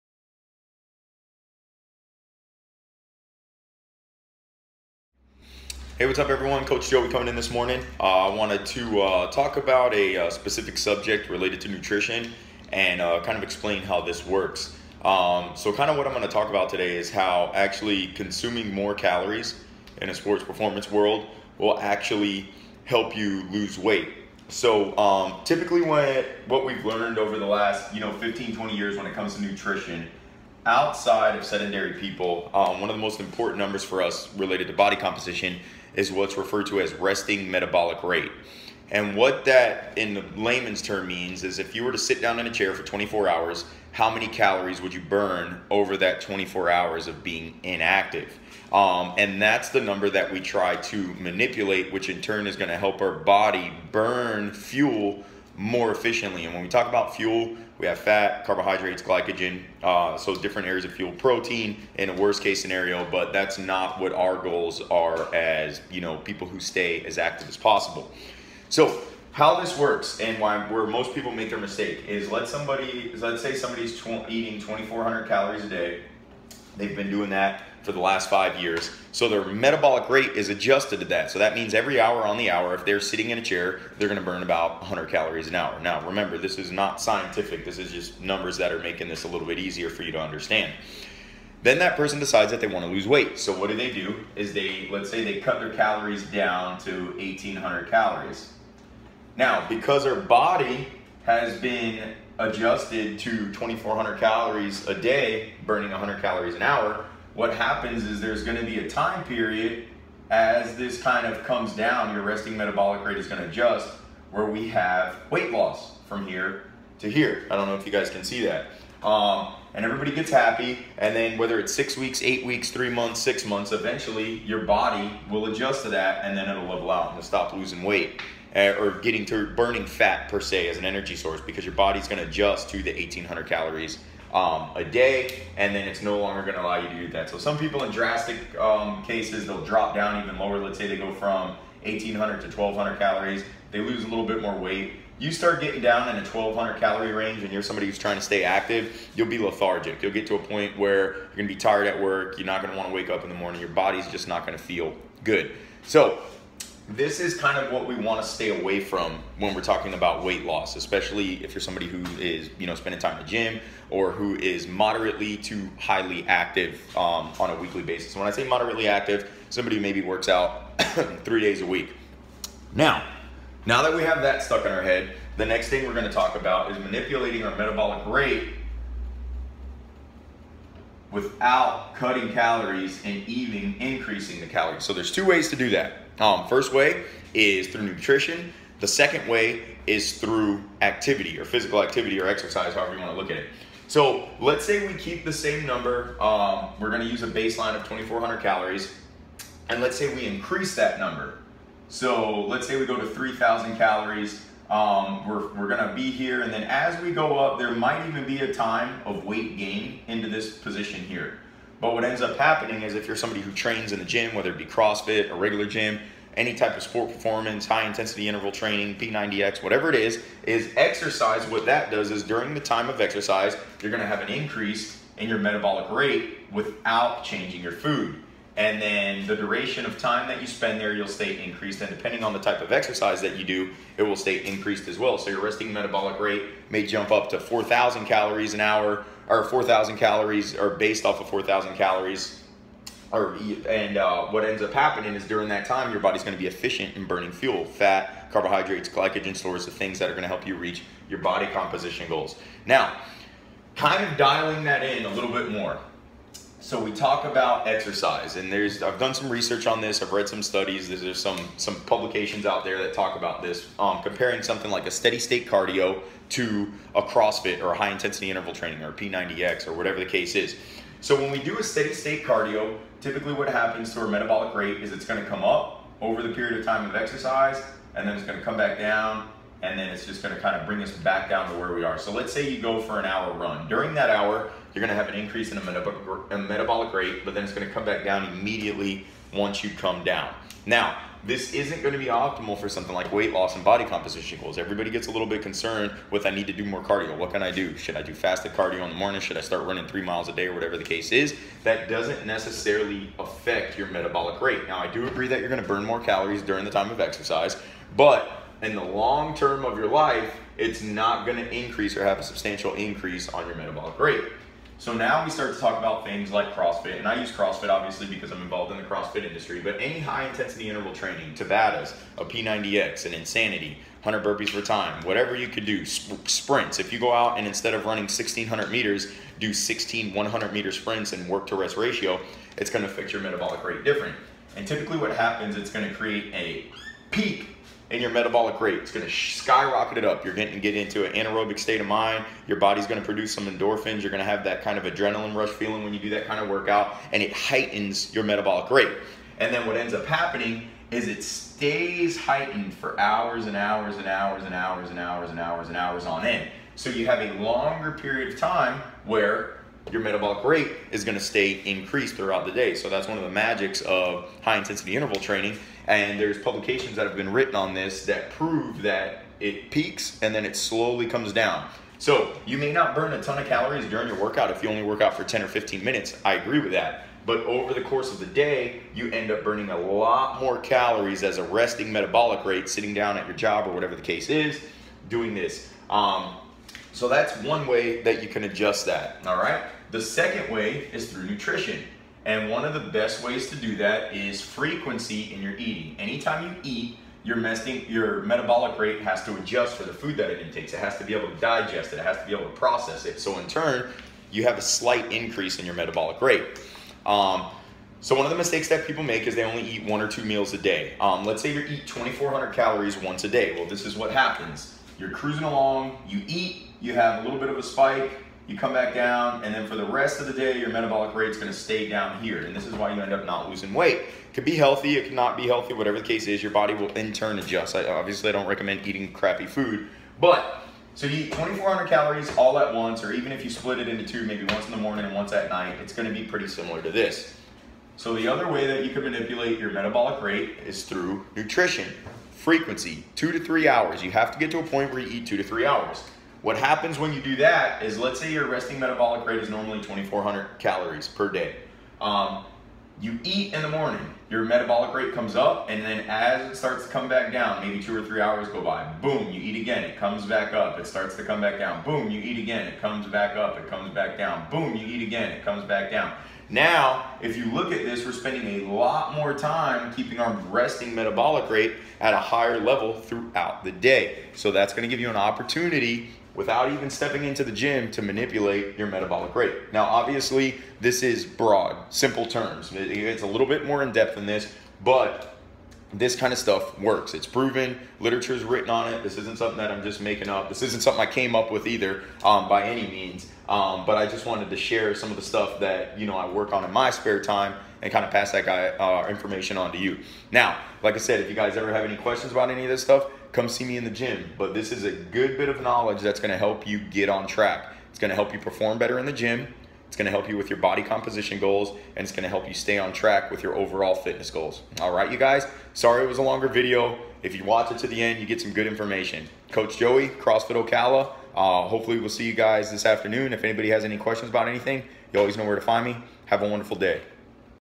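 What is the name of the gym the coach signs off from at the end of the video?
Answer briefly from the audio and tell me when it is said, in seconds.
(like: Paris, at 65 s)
CrossFit Ocala, at 520 s.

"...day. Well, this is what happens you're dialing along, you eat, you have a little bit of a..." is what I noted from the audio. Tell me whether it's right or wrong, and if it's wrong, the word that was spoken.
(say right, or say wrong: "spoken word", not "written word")
wrong: "cruising", not "dialing".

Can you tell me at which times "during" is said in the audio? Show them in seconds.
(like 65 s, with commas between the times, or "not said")
222 s, 245 s, 283 s, 306 s, 373 s.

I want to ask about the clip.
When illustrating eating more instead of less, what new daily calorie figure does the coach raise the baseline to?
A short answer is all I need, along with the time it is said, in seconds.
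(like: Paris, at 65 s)
3,000, at 203 s.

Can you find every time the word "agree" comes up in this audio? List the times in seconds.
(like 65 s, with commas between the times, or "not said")
305 s, 376 s.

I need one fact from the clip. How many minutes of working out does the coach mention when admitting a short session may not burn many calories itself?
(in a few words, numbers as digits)
10 or 15 minutes.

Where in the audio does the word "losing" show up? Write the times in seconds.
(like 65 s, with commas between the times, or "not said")
127 s, 423 s.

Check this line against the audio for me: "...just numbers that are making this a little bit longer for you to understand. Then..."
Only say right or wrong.
wrong.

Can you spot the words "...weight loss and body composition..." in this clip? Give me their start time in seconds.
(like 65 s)
293 s.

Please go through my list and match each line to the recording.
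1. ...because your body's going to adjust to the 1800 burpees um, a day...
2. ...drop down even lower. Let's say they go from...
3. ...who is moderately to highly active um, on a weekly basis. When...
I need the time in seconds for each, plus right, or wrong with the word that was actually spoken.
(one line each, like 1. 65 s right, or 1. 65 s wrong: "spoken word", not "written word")
1. 131 s wrong: "calories", not "burpees"
2. 139 s right
3. 164 s right.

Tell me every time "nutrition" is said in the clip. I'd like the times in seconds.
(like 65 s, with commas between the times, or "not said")
11 s, 29 s, 187 s, 391 s, 441 s.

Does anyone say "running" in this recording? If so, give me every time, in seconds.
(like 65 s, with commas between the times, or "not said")
299 s, 327 s.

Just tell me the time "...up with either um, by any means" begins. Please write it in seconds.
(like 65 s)
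491 s.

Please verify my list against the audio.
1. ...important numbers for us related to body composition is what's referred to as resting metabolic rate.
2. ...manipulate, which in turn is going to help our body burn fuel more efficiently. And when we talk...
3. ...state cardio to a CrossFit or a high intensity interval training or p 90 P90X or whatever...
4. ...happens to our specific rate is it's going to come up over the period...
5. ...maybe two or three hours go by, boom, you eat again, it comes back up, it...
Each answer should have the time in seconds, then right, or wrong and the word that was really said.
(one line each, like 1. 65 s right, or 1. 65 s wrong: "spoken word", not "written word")
1. 33 s right
2. 51 s right
3. 265 s right
4. 273 s wrong: "metabolic", not "specific"
5. 457 s right.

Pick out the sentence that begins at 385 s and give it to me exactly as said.
Um, so that's one way that you can adjust that, all right?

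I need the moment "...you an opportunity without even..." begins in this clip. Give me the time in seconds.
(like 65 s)
474 s.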